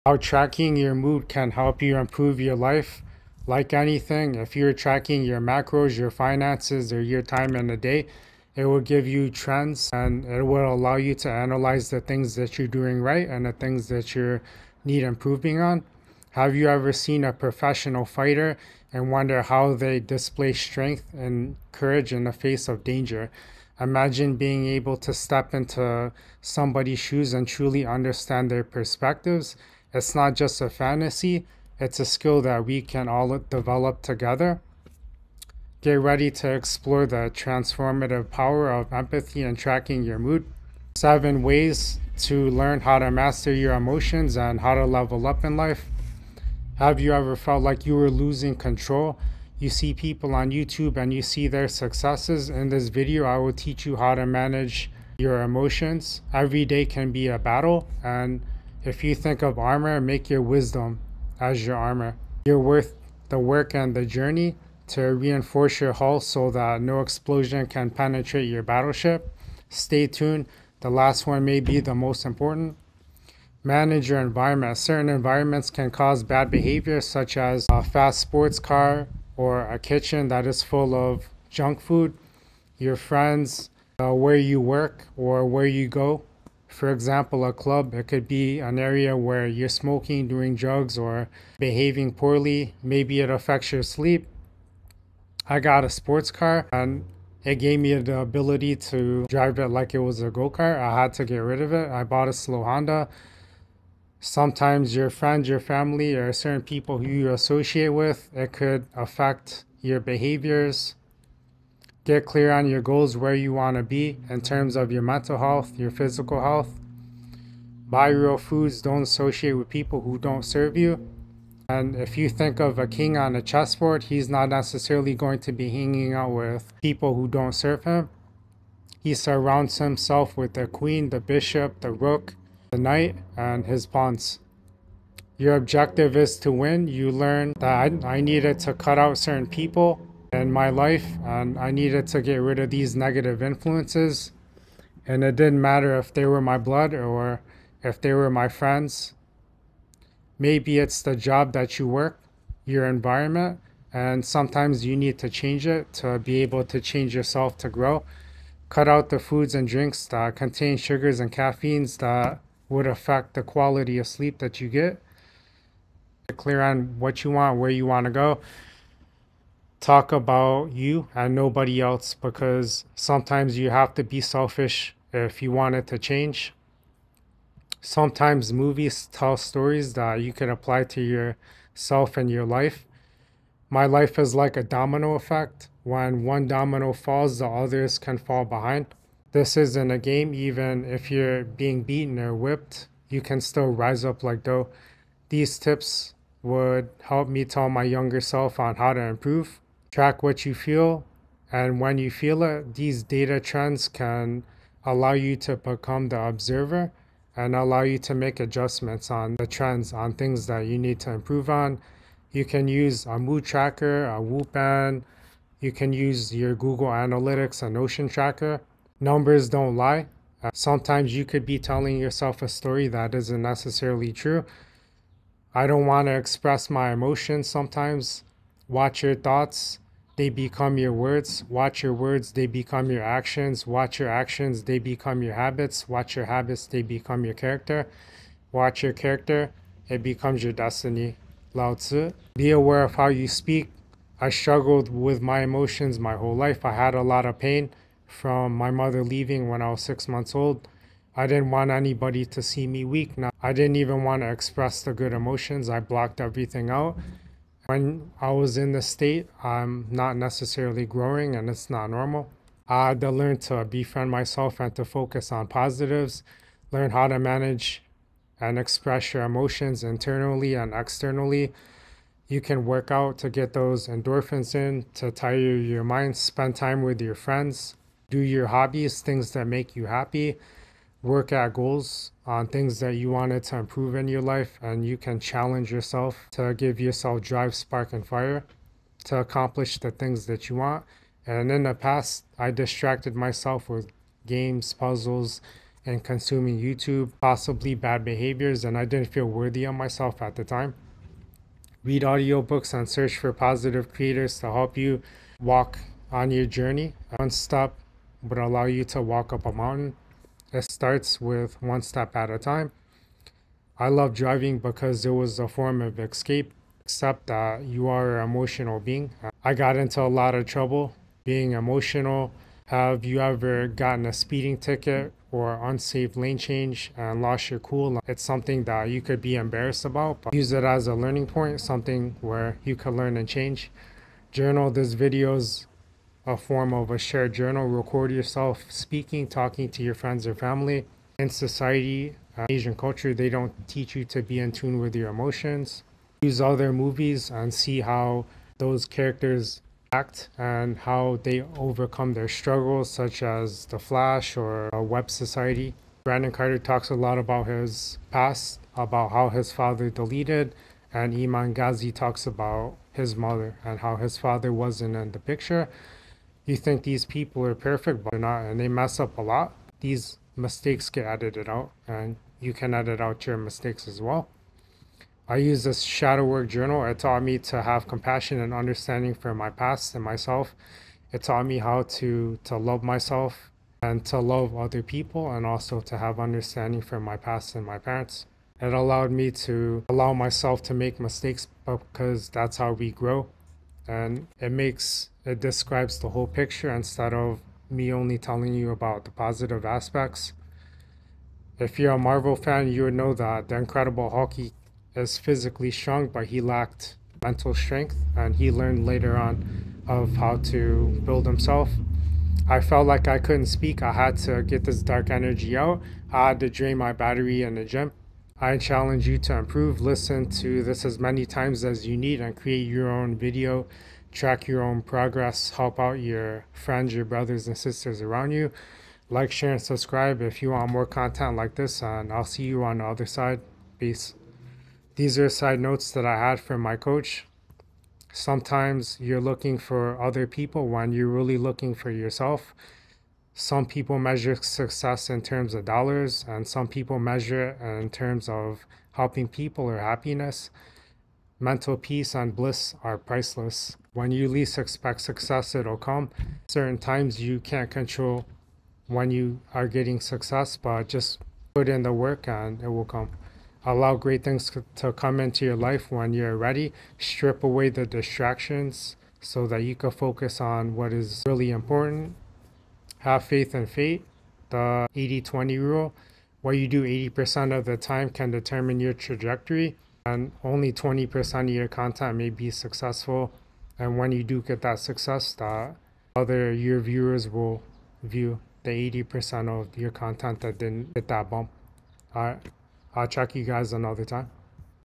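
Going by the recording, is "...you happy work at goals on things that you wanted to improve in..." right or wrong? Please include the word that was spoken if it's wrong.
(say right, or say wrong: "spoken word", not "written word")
right.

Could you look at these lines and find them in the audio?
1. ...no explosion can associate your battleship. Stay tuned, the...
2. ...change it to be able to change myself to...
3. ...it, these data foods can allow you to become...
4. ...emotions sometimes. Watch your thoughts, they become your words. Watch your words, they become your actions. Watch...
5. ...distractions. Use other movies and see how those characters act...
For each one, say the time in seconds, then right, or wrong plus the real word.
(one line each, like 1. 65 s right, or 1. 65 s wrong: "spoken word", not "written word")
1. 66 s wrong: "penetrate", not "associate"
2. 155 s wrong: "yourself", not "myself"
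3. 202 s wrong: "trends", not "foods"
4. 226 s right
5. 345 s wrong: "emotions", not "distractions".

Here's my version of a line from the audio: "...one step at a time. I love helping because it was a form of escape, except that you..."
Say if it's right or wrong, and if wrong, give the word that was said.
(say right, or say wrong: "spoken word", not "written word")
wrong: "driving", not "helping".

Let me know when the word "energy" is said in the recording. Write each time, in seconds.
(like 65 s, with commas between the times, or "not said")
415 s.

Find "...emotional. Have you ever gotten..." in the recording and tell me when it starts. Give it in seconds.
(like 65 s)
321 s.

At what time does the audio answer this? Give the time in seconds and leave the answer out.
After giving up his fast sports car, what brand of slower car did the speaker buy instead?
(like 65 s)
102 s.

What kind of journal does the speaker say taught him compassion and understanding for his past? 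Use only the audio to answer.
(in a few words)
Shadow work journal.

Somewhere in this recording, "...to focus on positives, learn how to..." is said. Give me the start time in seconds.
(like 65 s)
264 s.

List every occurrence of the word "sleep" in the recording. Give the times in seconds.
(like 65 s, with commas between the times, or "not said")
93 s, 164 s.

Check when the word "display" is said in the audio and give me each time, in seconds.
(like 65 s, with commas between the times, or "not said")
19 s.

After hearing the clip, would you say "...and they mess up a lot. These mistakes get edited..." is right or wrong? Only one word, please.
right.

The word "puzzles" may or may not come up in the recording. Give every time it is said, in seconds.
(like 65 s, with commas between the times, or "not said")
294 s.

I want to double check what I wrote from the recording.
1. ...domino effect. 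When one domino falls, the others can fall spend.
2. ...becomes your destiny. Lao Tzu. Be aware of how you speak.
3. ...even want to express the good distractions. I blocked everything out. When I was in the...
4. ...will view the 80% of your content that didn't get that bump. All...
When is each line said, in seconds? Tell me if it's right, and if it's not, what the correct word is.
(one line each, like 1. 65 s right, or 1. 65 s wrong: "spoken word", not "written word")
1. 184 s wrong: "behind", not "spend"
2. 240 s right
3. 253 s wrong: "emotions", not "distractions"
4. 487 s right.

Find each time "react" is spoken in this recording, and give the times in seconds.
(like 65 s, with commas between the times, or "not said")
not said.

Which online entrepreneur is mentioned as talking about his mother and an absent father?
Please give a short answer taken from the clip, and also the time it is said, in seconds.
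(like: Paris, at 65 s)
Iman Gadzhi, at 361 s.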